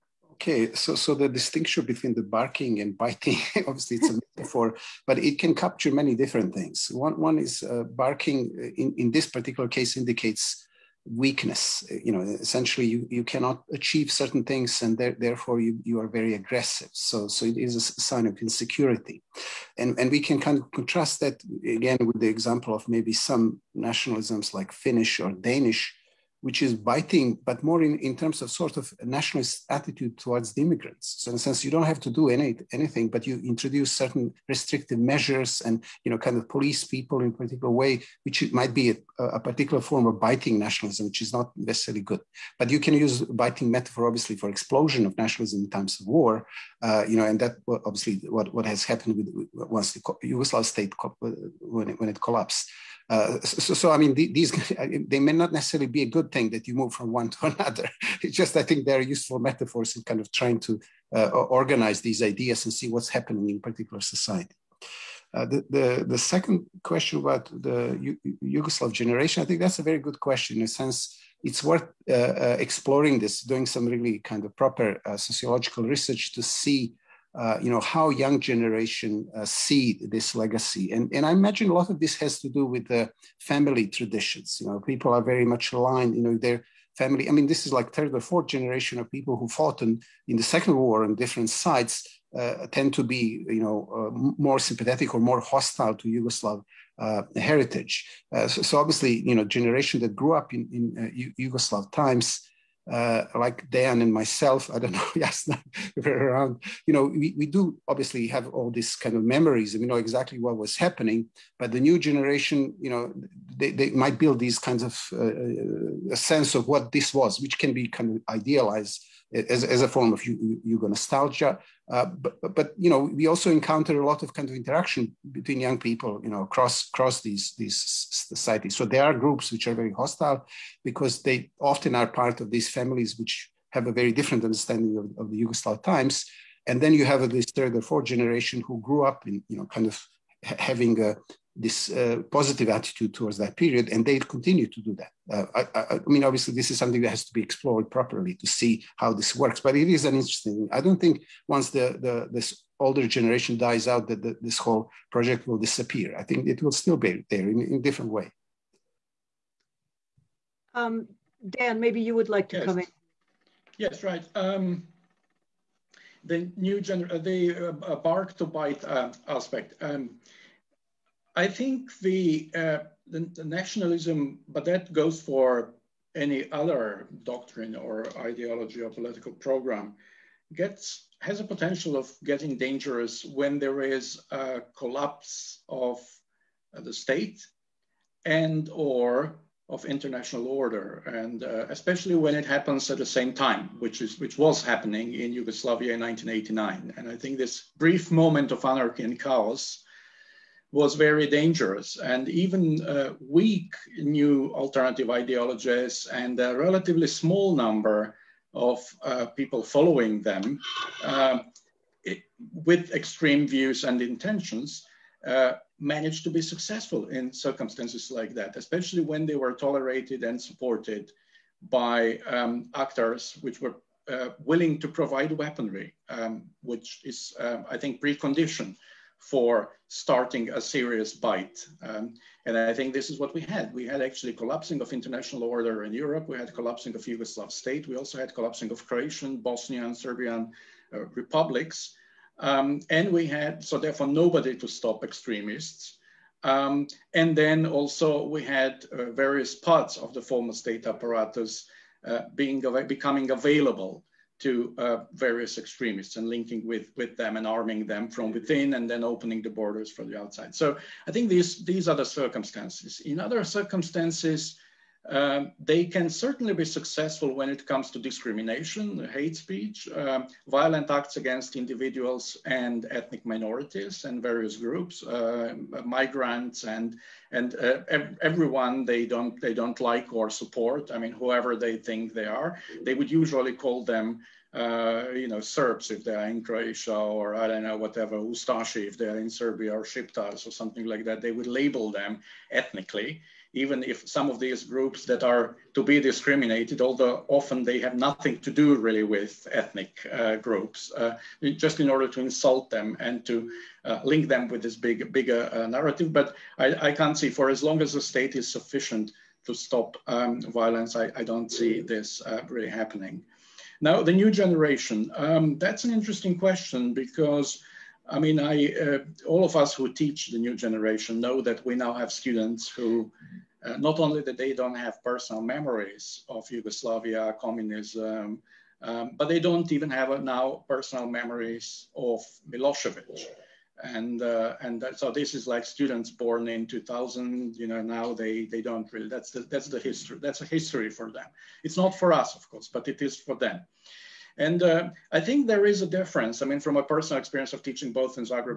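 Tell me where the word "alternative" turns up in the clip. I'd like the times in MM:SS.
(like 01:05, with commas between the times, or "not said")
03:24.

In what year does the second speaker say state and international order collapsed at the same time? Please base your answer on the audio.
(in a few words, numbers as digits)
1989.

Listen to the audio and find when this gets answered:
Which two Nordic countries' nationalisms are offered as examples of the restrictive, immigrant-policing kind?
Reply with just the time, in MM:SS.
00:24.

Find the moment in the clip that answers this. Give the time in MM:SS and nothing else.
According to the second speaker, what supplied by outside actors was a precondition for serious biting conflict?
03:45.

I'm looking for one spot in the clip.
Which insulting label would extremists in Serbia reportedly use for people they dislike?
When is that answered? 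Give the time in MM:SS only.
04:48.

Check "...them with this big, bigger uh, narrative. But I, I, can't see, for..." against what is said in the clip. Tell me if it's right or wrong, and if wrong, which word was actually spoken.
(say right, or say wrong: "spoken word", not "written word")
right.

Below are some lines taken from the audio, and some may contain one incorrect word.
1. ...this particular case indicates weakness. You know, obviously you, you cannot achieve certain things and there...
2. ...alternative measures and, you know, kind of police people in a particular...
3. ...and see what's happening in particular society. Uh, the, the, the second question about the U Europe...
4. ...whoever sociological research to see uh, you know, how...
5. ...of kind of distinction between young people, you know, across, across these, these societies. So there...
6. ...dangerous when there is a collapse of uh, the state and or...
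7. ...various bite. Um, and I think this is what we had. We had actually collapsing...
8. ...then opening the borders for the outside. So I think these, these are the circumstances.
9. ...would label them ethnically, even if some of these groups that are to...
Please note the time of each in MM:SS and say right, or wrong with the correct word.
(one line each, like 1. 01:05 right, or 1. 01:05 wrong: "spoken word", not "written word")
1. 00:09 wrong: "essentially", not "obviously"
2. 00:34 wrong: "restrictive", not "alternative"
3. 01:02 wrong: "Yugoslav", not "Europe"
4. 01:14 wrong: "proper", not "whoever"
5. 02:04 wrong: "interaction", not "distinction"
6. 03:02 right
7. 03:50 wrong: "serious", not "various"
8. 04:18 right
9. 04:51 right.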